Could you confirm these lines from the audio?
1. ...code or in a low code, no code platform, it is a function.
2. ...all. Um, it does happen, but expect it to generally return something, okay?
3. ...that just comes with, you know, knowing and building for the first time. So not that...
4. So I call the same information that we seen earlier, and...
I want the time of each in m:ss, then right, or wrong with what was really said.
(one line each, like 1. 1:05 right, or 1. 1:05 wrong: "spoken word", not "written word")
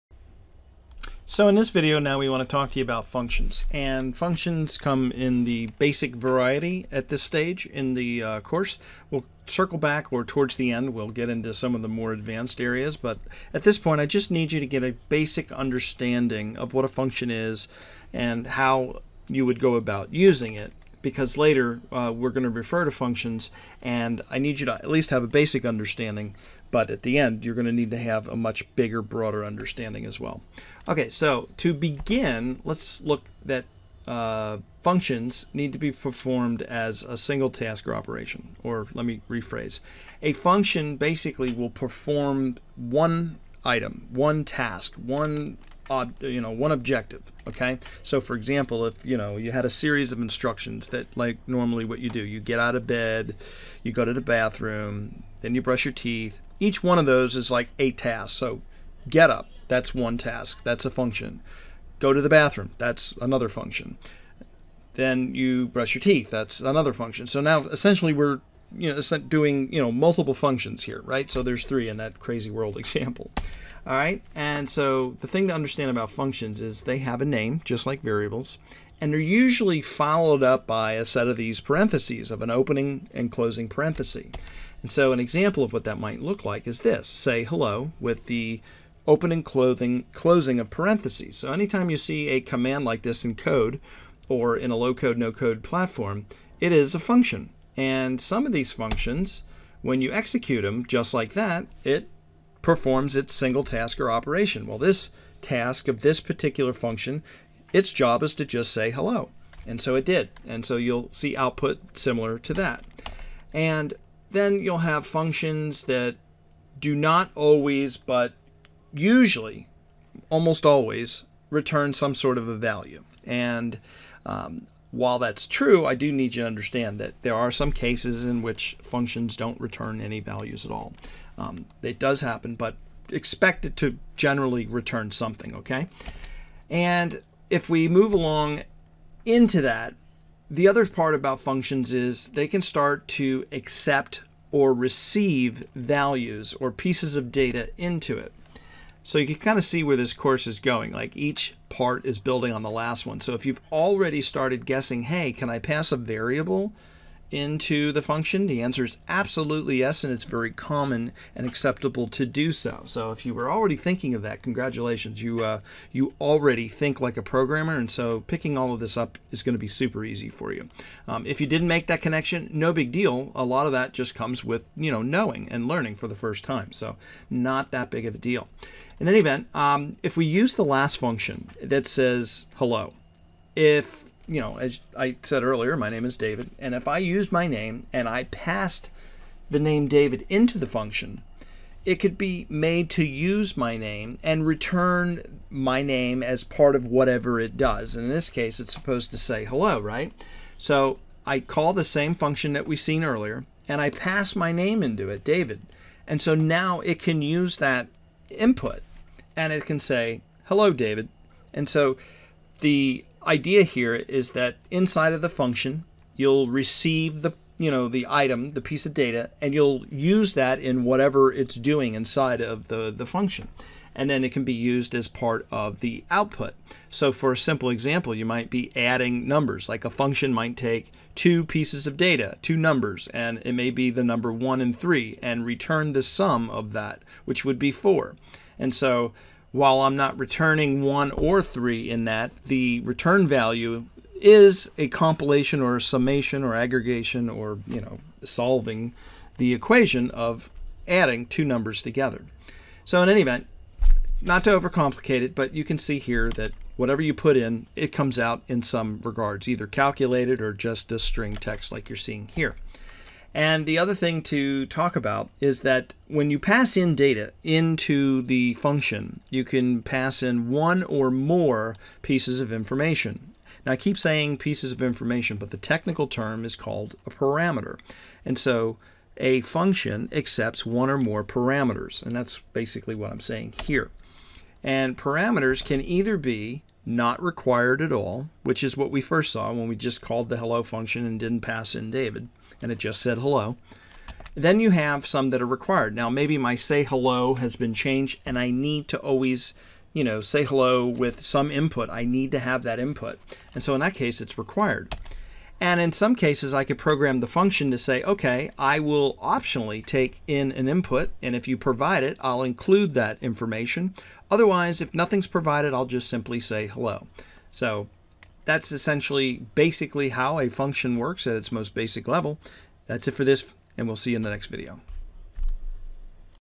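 1. 1:33 right
2. 2:10 right
3. 2:53 wrong: "learning", not "building"
4. 3:20 wrong: "function", not "information".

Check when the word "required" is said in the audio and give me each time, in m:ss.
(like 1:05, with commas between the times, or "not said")
4:47, 4:55, 5:04.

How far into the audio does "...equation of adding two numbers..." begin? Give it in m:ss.
4:09.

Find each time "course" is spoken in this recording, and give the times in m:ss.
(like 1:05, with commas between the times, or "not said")
0:08, 2:30.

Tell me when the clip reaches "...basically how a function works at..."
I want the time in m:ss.
5:19.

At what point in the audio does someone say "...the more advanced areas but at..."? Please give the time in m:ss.
0:11.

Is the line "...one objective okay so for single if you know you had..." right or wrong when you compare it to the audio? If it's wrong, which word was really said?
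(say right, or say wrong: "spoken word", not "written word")
wrong: "example", not "single".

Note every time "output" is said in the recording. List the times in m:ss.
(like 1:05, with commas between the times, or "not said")
1:51, 3:46.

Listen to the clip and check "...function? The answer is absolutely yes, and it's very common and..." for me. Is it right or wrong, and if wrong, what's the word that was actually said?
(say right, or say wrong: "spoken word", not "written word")
right.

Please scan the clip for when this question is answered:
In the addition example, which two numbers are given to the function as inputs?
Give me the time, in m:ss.
3:54.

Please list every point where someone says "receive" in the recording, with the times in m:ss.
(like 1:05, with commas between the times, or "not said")
2:24, 3:36.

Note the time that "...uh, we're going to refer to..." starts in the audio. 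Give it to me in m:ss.
0:21.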